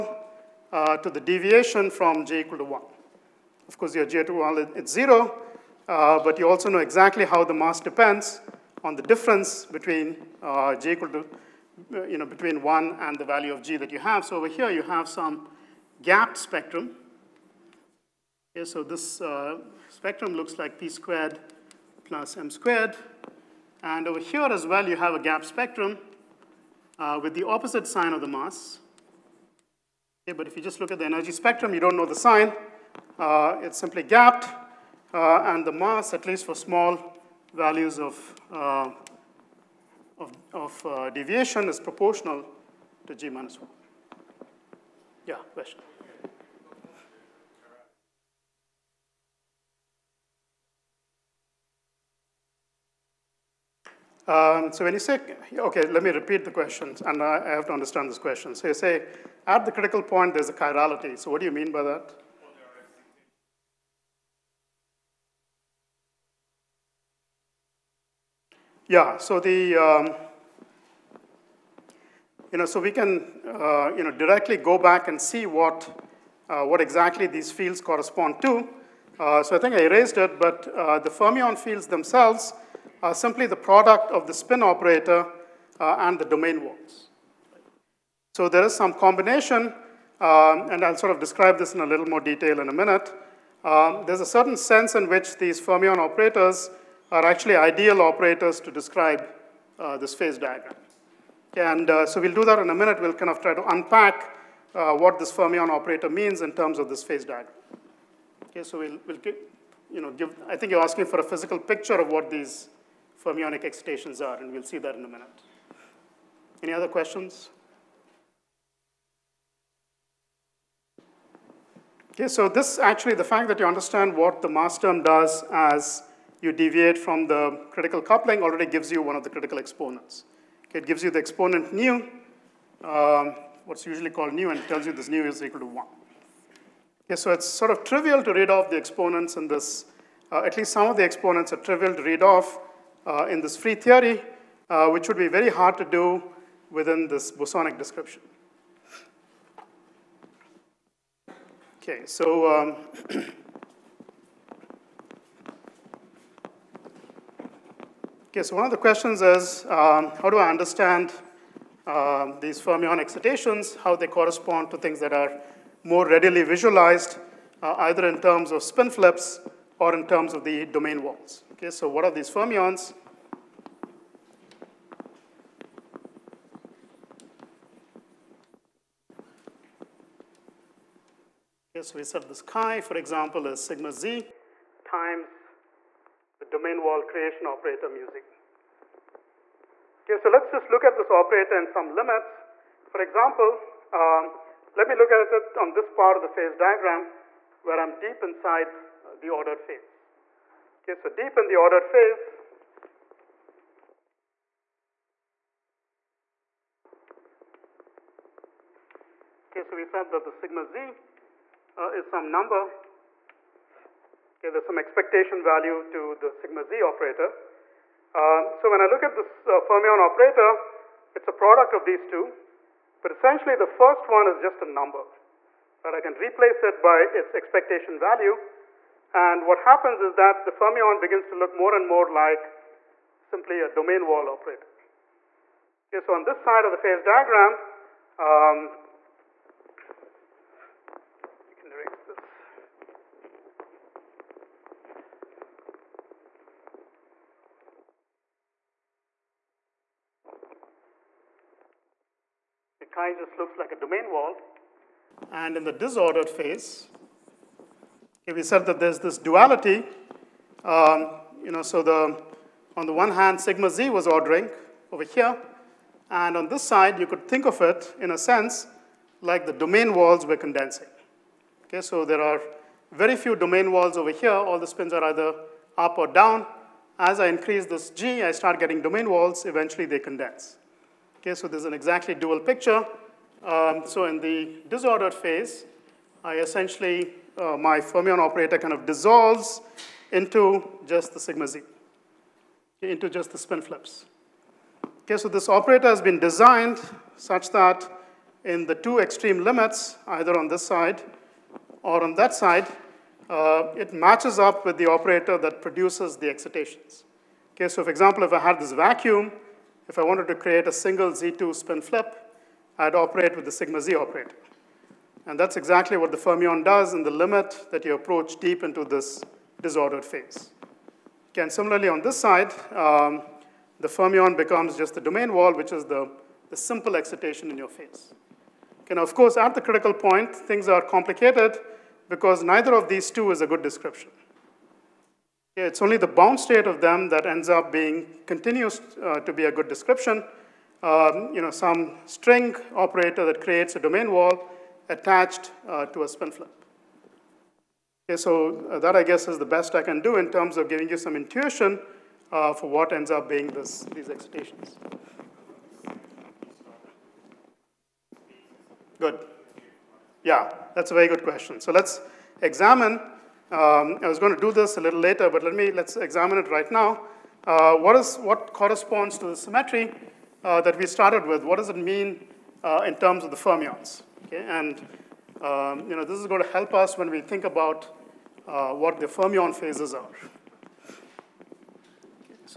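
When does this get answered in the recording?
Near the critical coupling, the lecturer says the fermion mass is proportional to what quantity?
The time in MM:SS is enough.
00:43.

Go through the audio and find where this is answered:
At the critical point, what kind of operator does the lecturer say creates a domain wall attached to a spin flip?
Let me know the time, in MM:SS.
05:42.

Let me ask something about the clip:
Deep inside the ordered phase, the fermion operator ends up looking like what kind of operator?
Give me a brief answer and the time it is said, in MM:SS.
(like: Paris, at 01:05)
domain wall operator, at 03:53.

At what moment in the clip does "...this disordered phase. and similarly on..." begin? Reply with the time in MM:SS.
05:18.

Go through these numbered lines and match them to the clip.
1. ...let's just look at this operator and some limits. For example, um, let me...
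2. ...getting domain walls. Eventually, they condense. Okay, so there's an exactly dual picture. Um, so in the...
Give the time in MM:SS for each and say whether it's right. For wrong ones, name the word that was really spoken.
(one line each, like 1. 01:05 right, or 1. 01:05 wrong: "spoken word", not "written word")
1. 03:10 right
2. 04:38 right.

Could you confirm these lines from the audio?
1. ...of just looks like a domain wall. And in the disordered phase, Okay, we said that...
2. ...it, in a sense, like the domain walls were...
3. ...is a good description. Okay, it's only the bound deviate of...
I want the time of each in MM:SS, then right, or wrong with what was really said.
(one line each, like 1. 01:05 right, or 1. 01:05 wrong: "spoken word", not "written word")
1. 04:13 right
2. 04:27 right
3. 05:33 wrong: "state", not "deviate".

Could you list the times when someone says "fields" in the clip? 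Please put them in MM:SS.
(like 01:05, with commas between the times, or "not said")
01:17, 01:21.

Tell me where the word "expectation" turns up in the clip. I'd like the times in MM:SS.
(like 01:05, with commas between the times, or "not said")
03:34, 03:47.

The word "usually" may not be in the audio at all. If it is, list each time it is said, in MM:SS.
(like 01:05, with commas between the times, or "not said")
02:13.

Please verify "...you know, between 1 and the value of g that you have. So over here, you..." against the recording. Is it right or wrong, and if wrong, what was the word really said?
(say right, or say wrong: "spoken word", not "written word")
right.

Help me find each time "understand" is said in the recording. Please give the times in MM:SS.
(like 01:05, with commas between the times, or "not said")
00:57, 02:03, 02:40.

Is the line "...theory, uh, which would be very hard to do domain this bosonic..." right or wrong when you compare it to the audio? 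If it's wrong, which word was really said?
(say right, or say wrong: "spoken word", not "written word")
wrong: "within", not "domain".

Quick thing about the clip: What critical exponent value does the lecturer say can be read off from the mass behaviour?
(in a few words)
nu equals 1.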